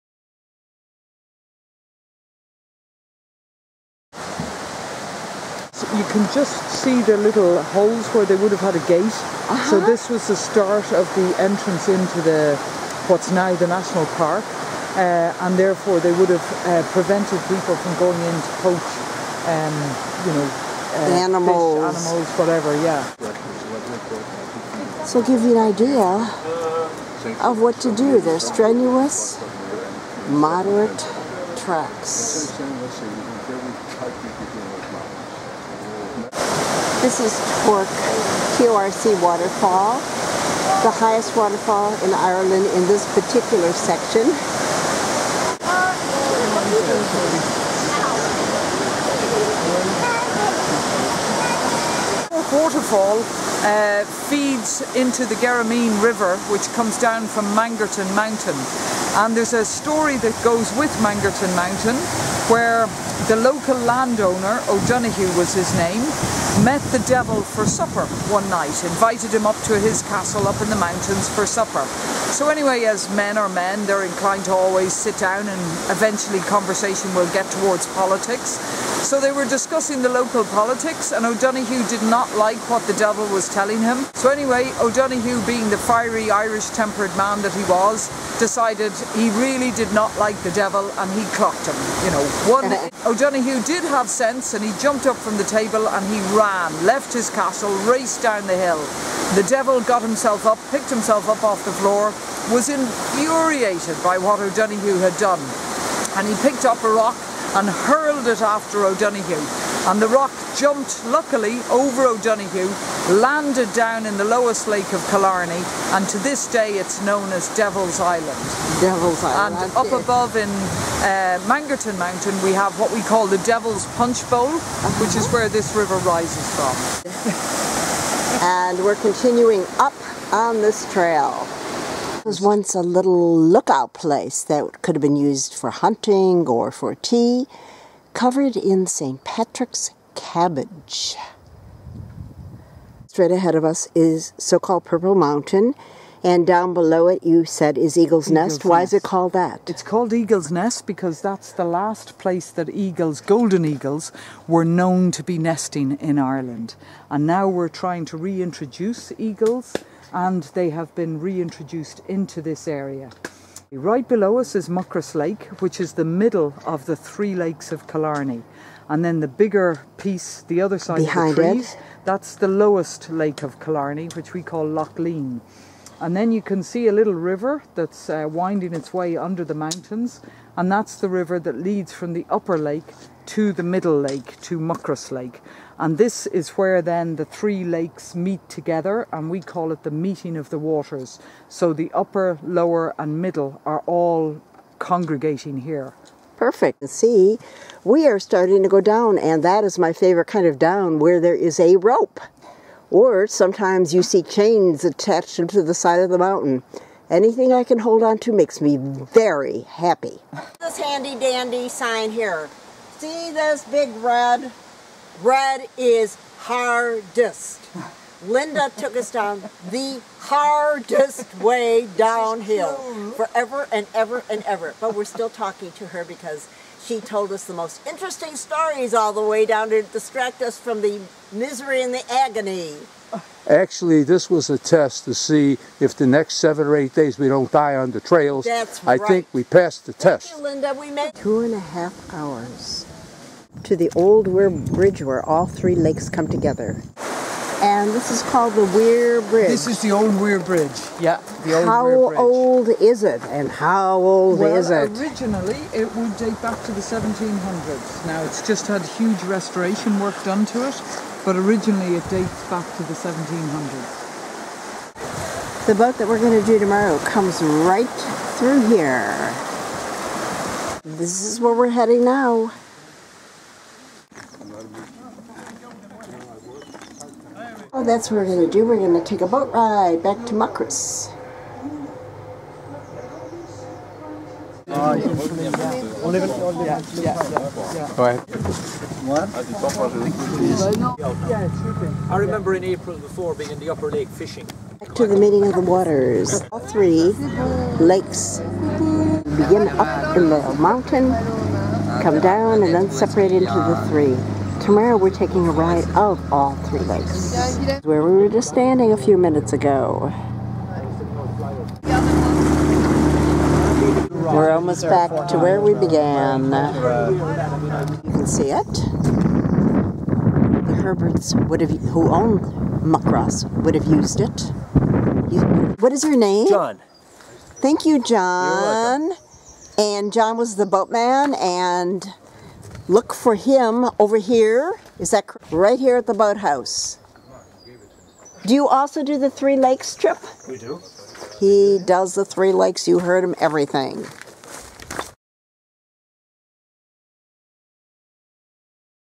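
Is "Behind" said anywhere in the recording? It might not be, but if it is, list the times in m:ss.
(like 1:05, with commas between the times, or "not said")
2:50.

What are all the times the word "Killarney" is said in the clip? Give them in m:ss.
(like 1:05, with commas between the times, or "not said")
1:55, 2:47, 2:53.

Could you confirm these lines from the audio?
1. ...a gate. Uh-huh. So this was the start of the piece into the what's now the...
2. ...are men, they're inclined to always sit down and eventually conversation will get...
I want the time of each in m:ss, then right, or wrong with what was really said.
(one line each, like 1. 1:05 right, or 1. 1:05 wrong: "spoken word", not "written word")
1. 0:08 wrong: "entrance", not "piece"
2. 1:13 right.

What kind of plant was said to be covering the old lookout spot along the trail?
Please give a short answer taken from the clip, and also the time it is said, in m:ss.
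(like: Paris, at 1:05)
St. Patrick's cabbage, at 2:18.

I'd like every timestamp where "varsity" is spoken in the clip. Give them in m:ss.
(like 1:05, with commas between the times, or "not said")
not said.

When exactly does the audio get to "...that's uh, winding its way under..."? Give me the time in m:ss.
2:57.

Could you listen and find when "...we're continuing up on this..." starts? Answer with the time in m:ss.
2:08.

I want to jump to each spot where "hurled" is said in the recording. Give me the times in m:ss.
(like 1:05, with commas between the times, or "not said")
1:47.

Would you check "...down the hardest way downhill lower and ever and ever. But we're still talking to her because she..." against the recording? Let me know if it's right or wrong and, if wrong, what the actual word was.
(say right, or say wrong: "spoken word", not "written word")
wrong: "forever", not "lower".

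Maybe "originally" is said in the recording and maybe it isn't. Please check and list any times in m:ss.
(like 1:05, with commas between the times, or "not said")
4:14, 4:21.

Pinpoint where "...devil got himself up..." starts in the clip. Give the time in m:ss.
1:39.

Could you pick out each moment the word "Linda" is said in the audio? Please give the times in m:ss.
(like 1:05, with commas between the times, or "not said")
3:38, 4:00.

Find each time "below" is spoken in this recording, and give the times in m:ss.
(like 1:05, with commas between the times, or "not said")
2:26, 2:44.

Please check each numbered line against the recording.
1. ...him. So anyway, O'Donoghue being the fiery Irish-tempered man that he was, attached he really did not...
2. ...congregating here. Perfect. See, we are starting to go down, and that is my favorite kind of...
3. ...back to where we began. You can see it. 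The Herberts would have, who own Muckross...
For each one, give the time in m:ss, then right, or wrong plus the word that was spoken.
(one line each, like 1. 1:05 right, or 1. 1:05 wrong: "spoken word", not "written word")
1. 1:23 wrong: "decided", not "attached"
2. 3:14 right
3. 5:14 right.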